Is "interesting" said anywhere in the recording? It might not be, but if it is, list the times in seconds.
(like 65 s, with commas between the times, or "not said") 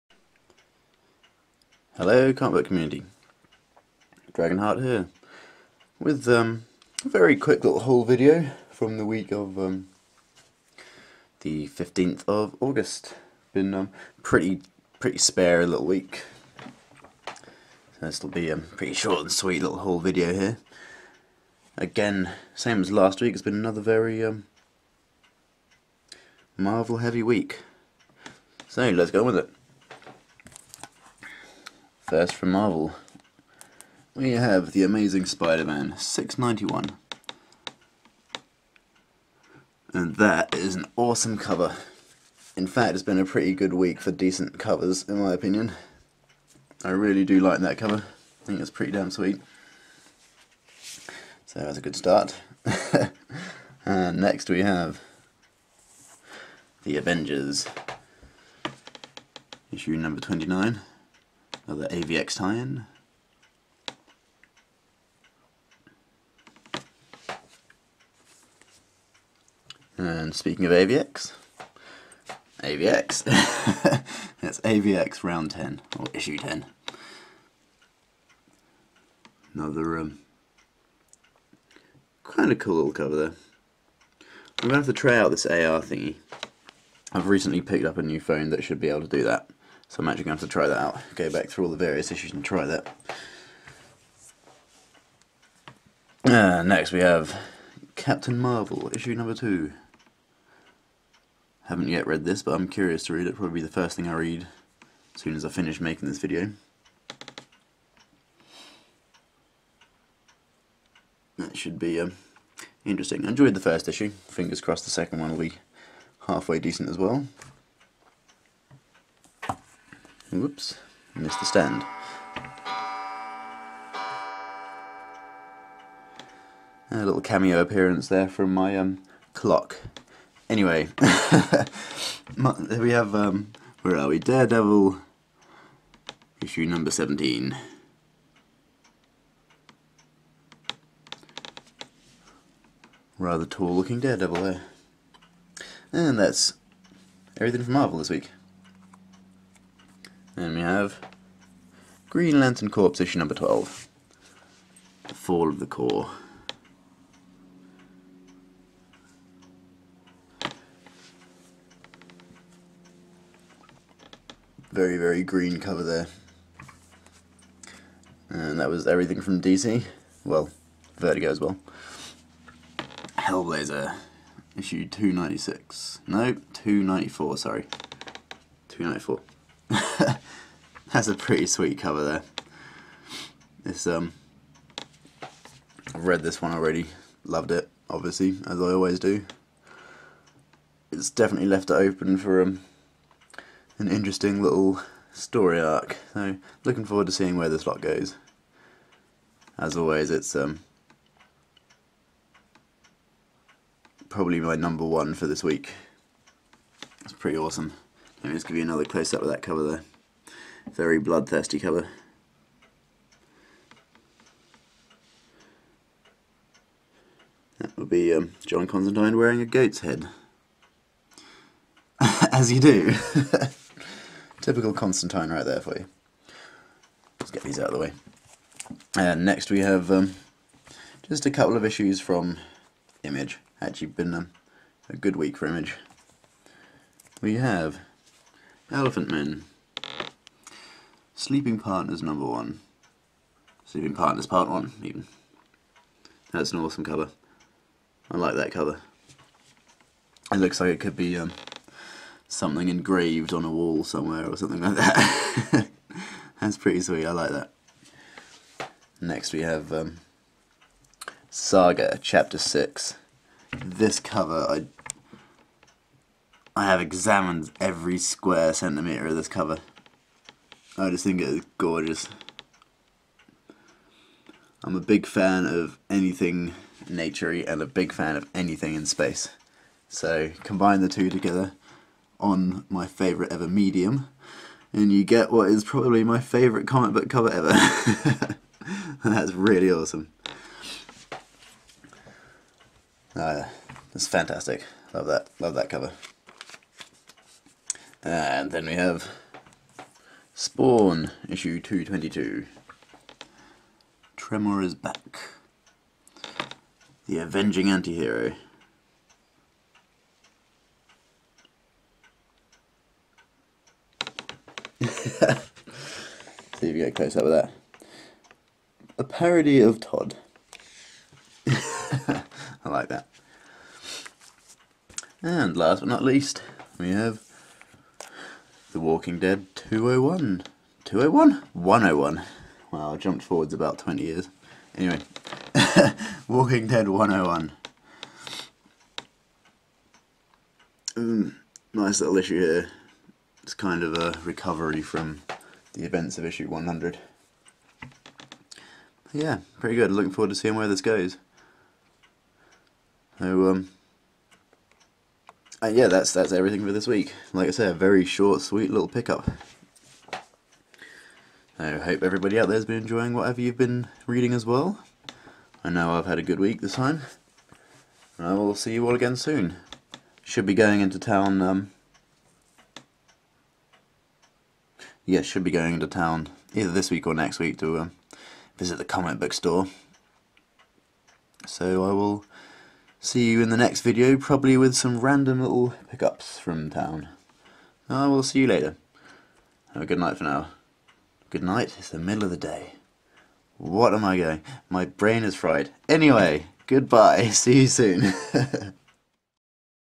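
112 s, 193 s.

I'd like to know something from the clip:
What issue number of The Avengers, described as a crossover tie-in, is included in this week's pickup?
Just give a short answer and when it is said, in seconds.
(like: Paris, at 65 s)
29, at 59 s.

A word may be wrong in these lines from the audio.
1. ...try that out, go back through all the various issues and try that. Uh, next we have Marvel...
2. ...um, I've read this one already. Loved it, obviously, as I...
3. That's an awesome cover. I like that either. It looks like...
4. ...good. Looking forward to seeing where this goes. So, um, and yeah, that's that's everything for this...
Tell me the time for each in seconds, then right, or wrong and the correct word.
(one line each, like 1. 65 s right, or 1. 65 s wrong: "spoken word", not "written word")
1. 90 s wrong: "Captain", not "Marvel"
2. 183 s right
3. 246 s wrong: "cover", not "either"
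4. 349 s right.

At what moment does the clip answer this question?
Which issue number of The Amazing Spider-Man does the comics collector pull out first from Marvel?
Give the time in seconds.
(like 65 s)
35 s.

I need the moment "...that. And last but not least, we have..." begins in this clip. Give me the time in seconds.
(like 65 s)
322 s.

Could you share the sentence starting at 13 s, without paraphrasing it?
Been um, pretty pretty spare a little week, so this will be a um, pretty short and sweet little haul video here.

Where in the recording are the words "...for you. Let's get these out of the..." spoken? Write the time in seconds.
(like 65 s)
225 s.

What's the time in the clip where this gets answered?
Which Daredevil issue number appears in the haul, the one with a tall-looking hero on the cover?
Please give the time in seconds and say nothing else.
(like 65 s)
136 s.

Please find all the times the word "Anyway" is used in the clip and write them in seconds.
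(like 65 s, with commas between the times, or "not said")
130 s, 334 s, 395 s.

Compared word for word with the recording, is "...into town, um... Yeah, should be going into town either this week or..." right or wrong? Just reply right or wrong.
right.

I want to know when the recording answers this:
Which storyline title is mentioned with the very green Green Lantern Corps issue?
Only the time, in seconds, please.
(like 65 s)
155 s.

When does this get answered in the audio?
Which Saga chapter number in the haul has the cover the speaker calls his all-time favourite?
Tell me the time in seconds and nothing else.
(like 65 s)
262 s.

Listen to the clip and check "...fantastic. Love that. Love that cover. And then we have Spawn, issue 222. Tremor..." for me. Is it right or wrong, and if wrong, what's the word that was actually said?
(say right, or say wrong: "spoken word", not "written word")
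right.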